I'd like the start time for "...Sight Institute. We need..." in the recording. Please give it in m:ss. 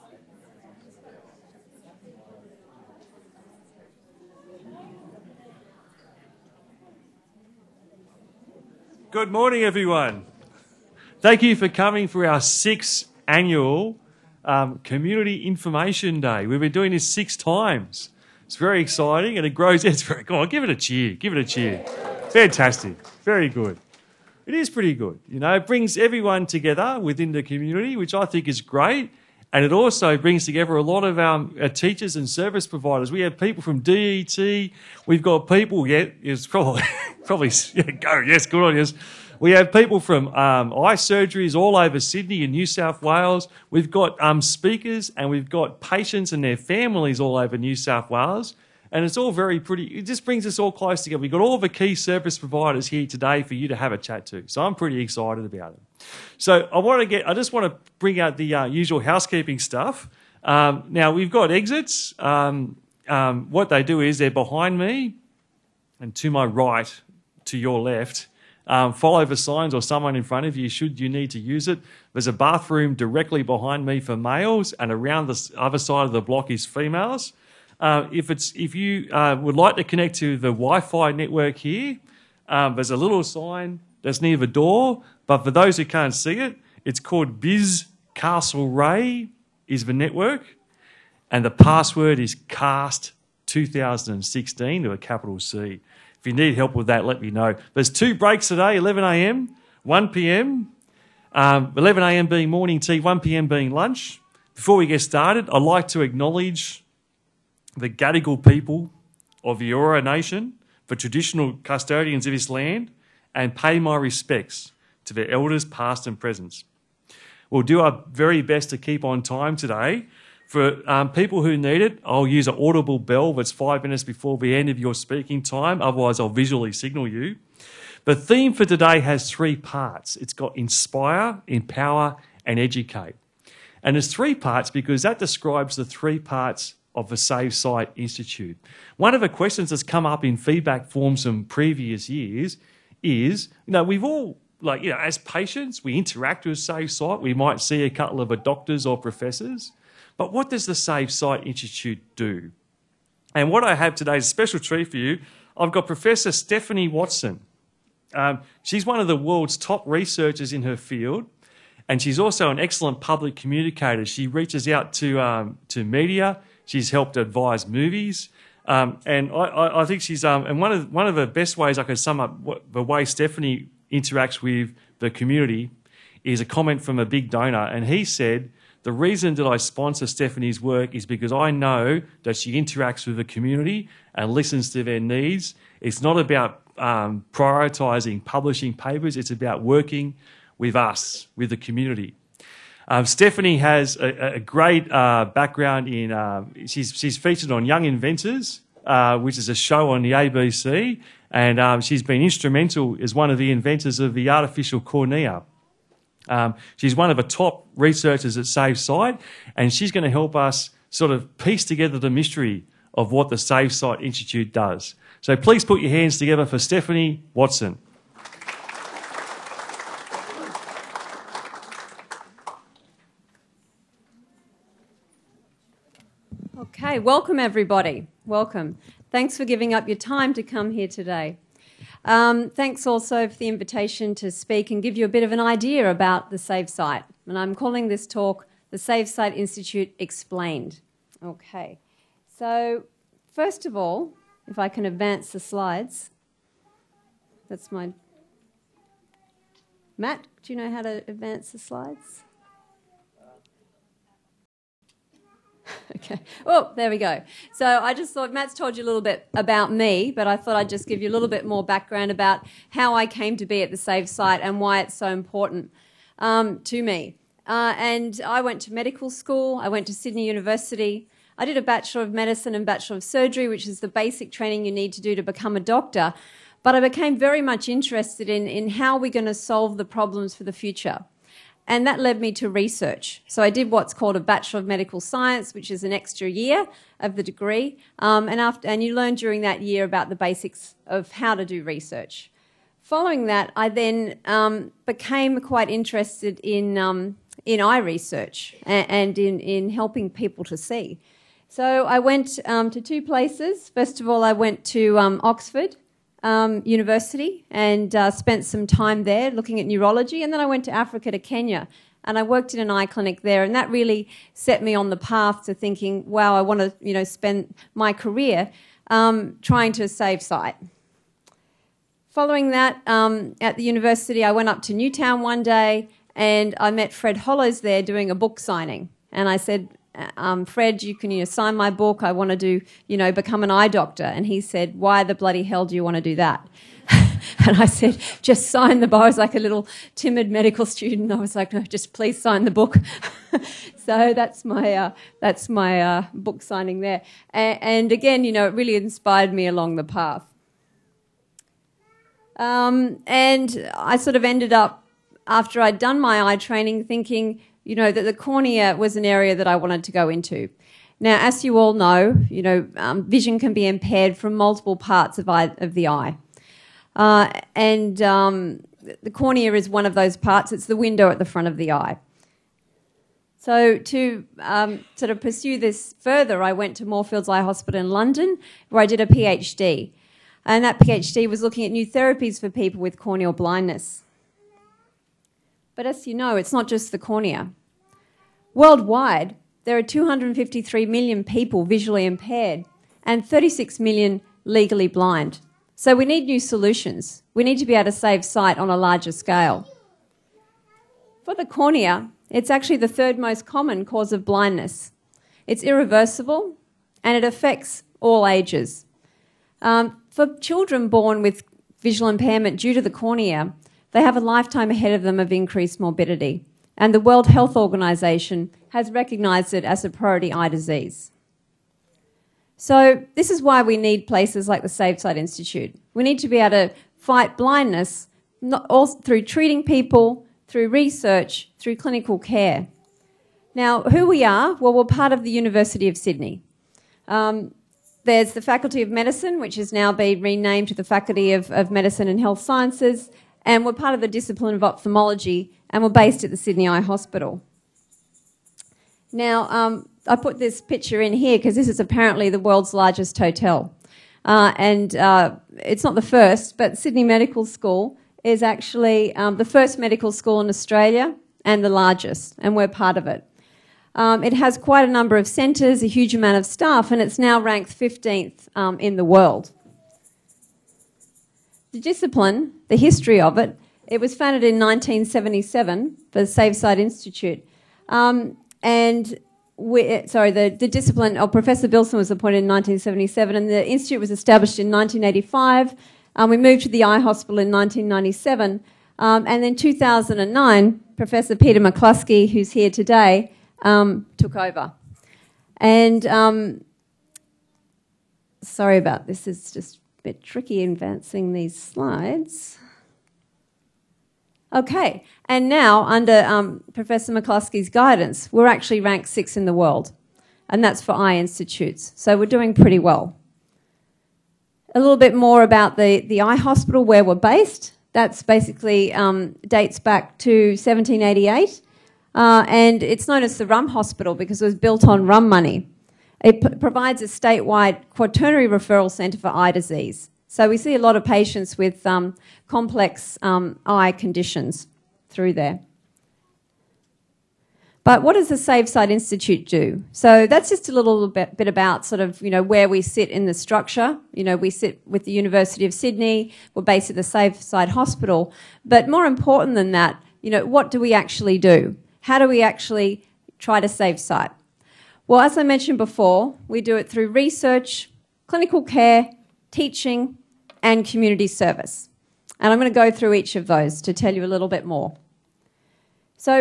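7:04.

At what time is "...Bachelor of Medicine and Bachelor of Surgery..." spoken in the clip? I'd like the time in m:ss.
4:31.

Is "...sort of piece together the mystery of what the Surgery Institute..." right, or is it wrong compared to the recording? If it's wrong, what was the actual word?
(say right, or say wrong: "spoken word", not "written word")
wrong: "Safe", not "Surgery".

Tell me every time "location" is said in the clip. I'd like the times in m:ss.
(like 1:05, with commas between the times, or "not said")
not said.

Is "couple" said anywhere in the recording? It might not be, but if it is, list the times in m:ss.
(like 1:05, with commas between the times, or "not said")
2:27.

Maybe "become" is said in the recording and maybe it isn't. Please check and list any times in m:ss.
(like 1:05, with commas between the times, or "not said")
4:35, 5:33.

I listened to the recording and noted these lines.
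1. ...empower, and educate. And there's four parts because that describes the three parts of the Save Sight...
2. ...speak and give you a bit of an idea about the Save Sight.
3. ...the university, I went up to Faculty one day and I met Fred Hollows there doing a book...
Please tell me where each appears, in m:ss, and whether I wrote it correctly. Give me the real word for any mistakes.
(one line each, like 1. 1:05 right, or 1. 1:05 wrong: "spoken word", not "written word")
1. 2:11 wrong: "three", not "four"
2. 3:54 right
3. 5:23 wrong: "Newtown", not "Faculty".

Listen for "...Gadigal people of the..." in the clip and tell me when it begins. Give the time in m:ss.
1:47.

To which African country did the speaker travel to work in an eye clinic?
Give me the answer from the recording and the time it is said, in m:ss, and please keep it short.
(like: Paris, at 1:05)
Kenya, at 5:11.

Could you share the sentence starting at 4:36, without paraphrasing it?
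But I became very much interested in, in how we're going to solve the problems for the future.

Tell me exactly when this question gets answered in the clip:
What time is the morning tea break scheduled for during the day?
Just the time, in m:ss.
1:41.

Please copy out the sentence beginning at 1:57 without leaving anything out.
We'll do our very best to keep on time today.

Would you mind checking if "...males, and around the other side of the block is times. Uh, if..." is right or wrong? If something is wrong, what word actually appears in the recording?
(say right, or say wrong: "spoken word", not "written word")
wrong: "females", not "times".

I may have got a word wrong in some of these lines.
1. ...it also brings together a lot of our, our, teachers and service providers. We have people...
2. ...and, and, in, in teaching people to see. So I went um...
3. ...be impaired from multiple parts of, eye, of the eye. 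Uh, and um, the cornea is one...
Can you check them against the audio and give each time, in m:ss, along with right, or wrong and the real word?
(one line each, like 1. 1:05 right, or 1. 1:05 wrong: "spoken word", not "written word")
1. 0:29 right
2. 4:58 wrong: "helping", not "teaching"
3. 6:03 right.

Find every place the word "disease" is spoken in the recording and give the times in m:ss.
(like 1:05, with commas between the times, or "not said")
7:00, 8:49.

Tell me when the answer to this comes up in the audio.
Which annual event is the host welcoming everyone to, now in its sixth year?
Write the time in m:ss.
0:14.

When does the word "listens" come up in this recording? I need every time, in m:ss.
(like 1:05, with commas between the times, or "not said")
3:04.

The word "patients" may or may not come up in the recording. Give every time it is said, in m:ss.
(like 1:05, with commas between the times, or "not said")
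0:45, 2:25, 8:51.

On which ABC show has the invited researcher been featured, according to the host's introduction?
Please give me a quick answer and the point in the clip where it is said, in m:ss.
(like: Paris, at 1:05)
Young Inventors, at 3:17.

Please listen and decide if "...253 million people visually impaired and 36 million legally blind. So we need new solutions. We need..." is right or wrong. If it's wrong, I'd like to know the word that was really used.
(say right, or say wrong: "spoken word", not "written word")
right.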